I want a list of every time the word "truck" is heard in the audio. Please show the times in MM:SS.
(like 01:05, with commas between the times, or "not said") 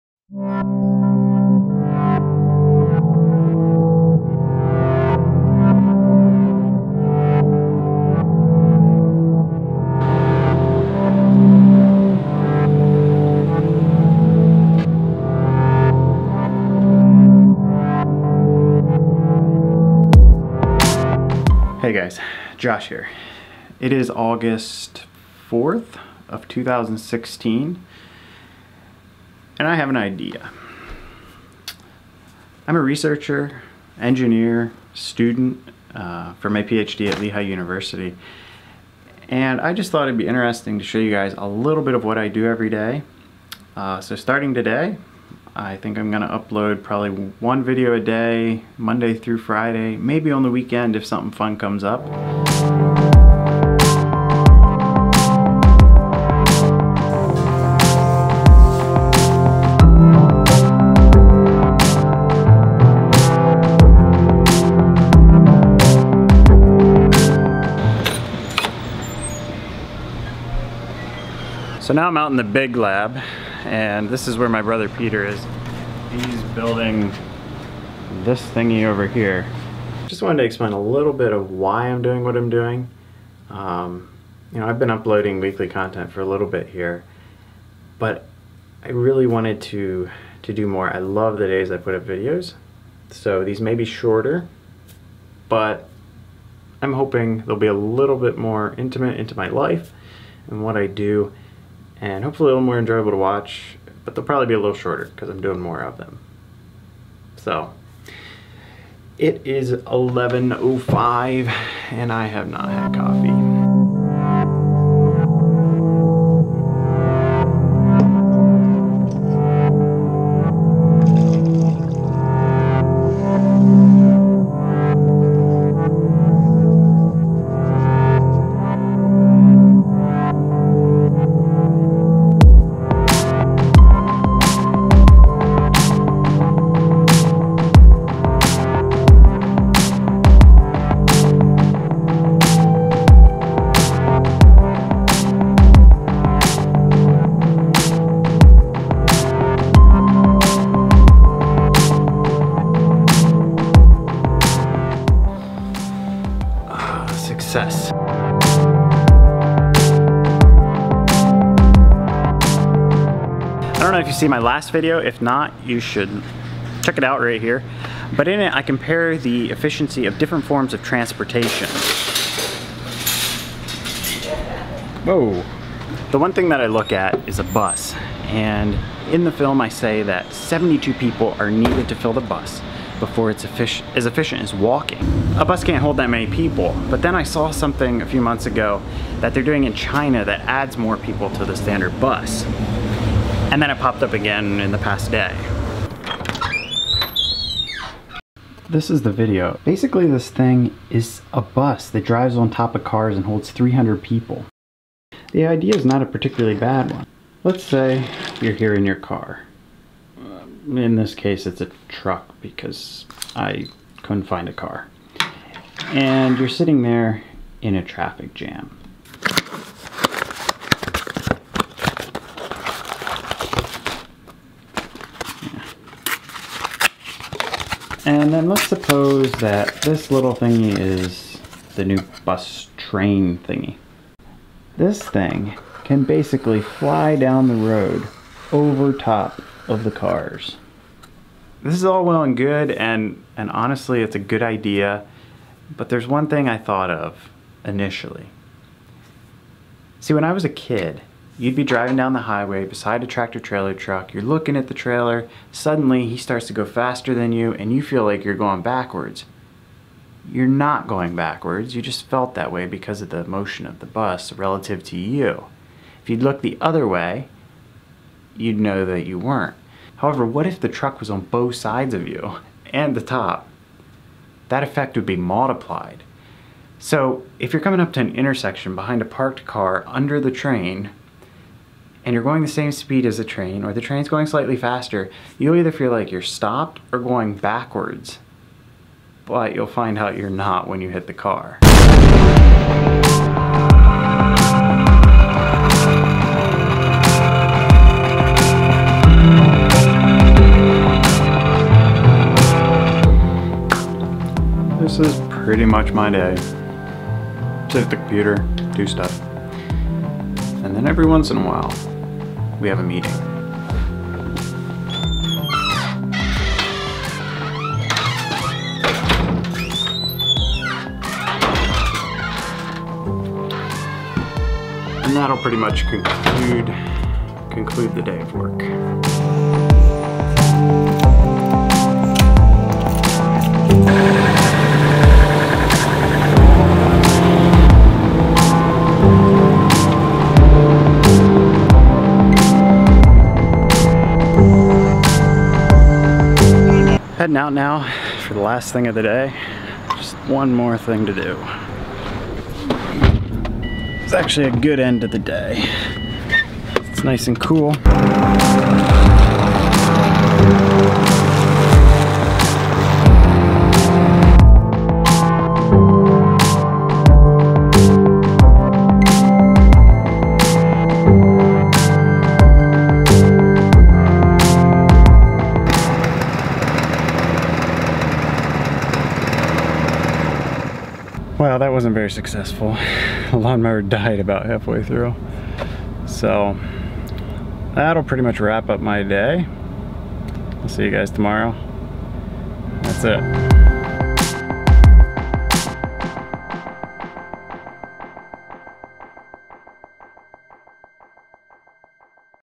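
03:31, 04:13, 04:30.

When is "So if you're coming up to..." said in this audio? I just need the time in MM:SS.
04:36.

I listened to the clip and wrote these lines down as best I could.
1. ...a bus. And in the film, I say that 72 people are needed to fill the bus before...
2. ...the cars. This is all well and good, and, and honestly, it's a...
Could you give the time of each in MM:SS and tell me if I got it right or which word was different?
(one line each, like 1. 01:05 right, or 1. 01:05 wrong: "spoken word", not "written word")
1. 02:57 right
2. 03:59 right.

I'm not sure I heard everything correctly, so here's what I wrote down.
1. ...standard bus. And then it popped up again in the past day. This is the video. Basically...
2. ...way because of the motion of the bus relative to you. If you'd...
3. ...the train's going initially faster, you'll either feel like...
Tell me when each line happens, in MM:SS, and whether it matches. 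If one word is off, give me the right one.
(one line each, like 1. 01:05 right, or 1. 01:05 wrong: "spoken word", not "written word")
1. 03:11 right
2. 04:22 right
3. 04:43 wrong: "slightly", not "initially".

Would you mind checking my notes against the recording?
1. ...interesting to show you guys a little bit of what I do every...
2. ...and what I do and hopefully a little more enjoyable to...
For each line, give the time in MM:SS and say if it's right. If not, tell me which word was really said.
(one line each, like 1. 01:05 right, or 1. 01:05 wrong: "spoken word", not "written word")
1. 00:40 right
2. 01:40 right.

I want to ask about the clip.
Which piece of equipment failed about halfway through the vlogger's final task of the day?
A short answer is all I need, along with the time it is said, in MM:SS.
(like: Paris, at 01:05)
The lawnmower, at 06:23.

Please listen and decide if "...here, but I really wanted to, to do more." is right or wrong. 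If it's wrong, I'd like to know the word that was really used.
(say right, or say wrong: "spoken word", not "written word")
right.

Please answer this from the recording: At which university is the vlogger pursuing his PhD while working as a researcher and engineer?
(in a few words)
Lehigh University.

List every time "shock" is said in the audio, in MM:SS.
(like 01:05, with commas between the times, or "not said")
not said.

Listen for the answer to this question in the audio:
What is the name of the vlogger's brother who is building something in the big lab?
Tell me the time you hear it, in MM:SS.
01:14.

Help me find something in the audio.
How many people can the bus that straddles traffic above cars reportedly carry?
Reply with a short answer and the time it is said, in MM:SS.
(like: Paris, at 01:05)
300, at 03:23.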